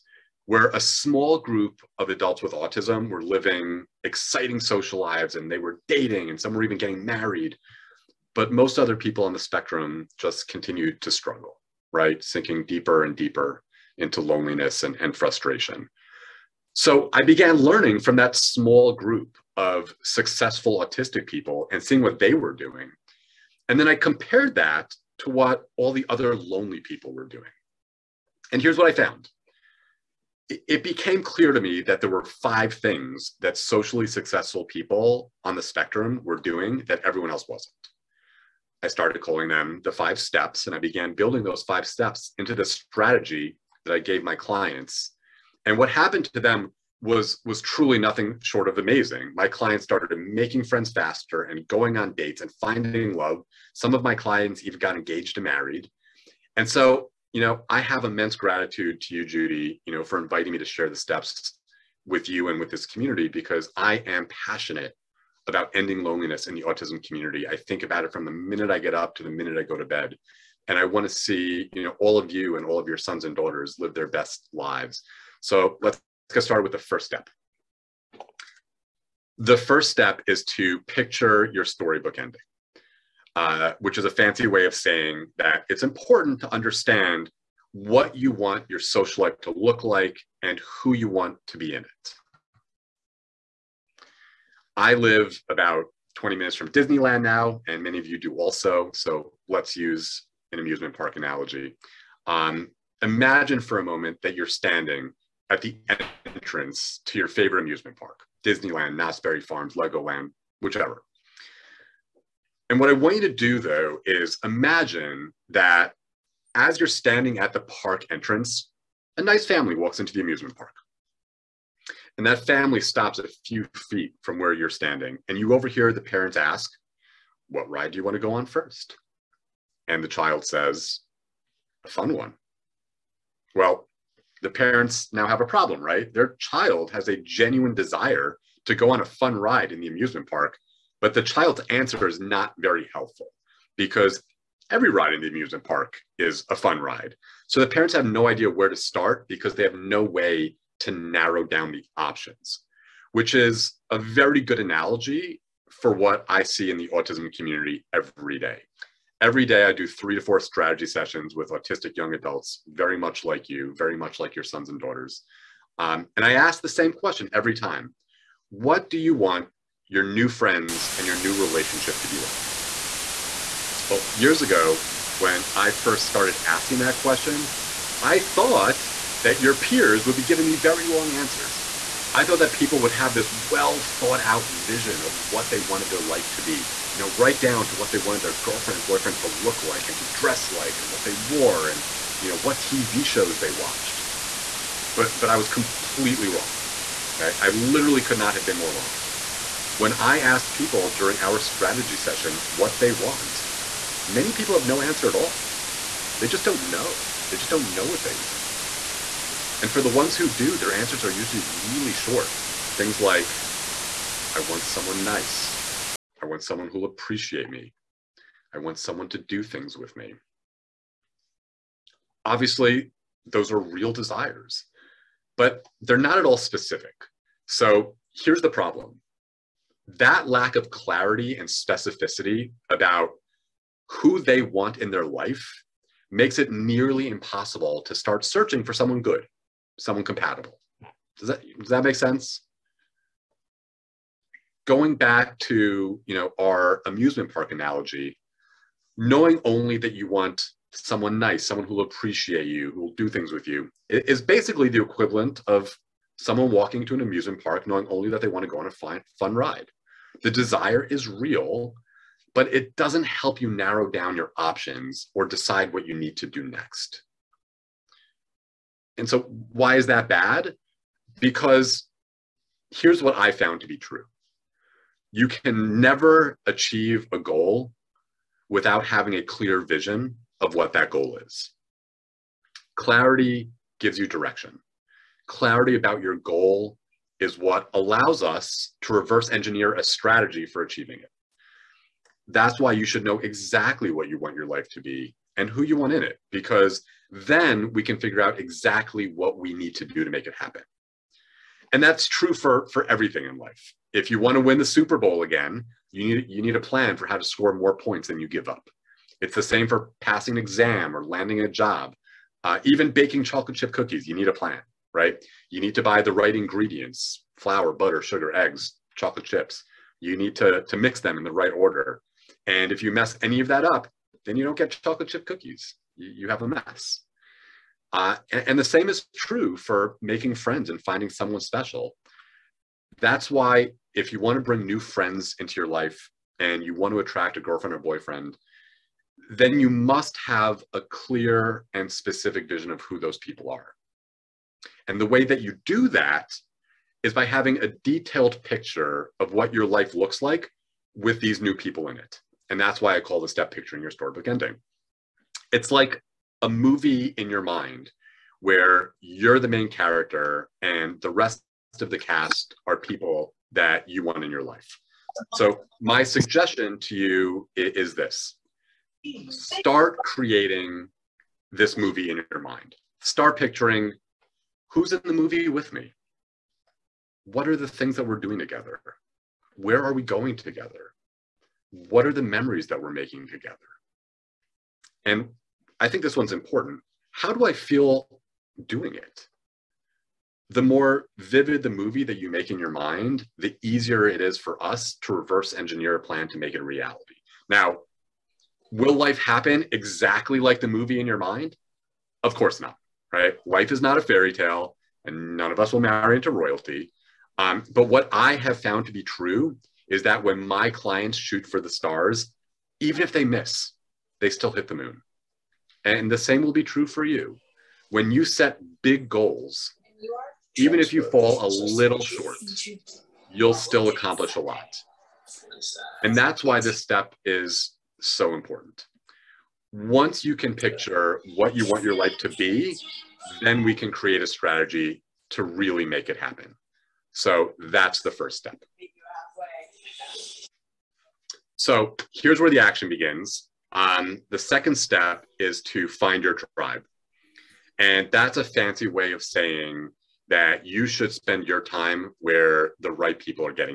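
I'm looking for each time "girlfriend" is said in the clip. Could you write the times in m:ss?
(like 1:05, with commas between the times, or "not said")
3:08, 5:37.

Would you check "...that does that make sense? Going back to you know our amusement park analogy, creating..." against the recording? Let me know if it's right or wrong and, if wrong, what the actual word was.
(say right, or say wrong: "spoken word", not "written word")
wrong: "knowing", not "creating".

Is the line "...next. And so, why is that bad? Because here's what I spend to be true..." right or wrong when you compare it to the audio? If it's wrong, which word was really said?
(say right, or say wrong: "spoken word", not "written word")
wrong: "found", not "spend".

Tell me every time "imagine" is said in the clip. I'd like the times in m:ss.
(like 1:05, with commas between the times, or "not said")
1:43, 1:54.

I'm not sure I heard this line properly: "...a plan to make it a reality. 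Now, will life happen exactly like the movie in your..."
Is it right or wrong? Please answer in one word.
right.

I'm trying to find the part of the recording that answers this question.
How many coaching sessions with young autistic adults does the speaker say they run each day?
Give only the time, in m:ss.
2:39.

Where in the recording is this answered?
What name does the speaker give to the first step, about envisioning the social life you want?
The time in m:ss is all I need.
1:20.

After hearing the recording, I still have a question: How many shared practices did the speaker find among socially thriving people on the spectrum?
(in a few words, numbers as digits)
5.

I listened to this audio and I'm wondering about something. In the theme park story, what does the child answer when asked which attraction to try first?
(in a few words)
A fun one.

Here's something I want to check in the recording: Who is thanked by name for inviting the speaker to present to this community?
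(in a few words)
Judy.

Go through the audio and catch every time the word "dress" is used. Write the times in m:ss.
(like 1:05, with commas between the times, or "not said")
3:10.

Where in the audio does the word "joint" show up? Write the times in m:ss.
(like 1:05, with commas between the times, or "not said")
not said.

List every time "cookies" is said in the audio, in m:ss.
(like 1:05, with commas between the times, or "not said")
5:13, 5:25.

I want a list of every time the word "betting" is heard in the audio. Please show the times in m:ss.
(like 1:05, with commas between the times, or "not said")
not said.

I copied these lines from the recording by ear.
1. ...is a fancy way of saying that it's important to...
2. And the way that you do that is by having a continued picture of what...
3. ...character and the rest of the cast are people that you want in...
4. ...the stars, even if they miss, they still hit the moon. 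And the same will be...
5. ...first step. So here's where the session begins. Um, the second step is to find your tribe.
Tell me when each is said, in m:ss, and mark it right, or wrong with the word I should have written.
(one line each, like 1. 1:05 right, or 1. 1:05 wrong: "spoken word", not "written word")
1. 1:23 right
2. 5:44 wrong: "detailed", not "continued"
3. 5:59 right
4. 6:51 right
5. 7:18 wrong: "action", not "session".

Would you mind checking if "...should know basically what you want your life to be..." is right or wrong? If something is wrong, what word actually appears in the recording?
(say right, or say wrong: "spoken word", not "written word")
wrong: "exactly", not "basically".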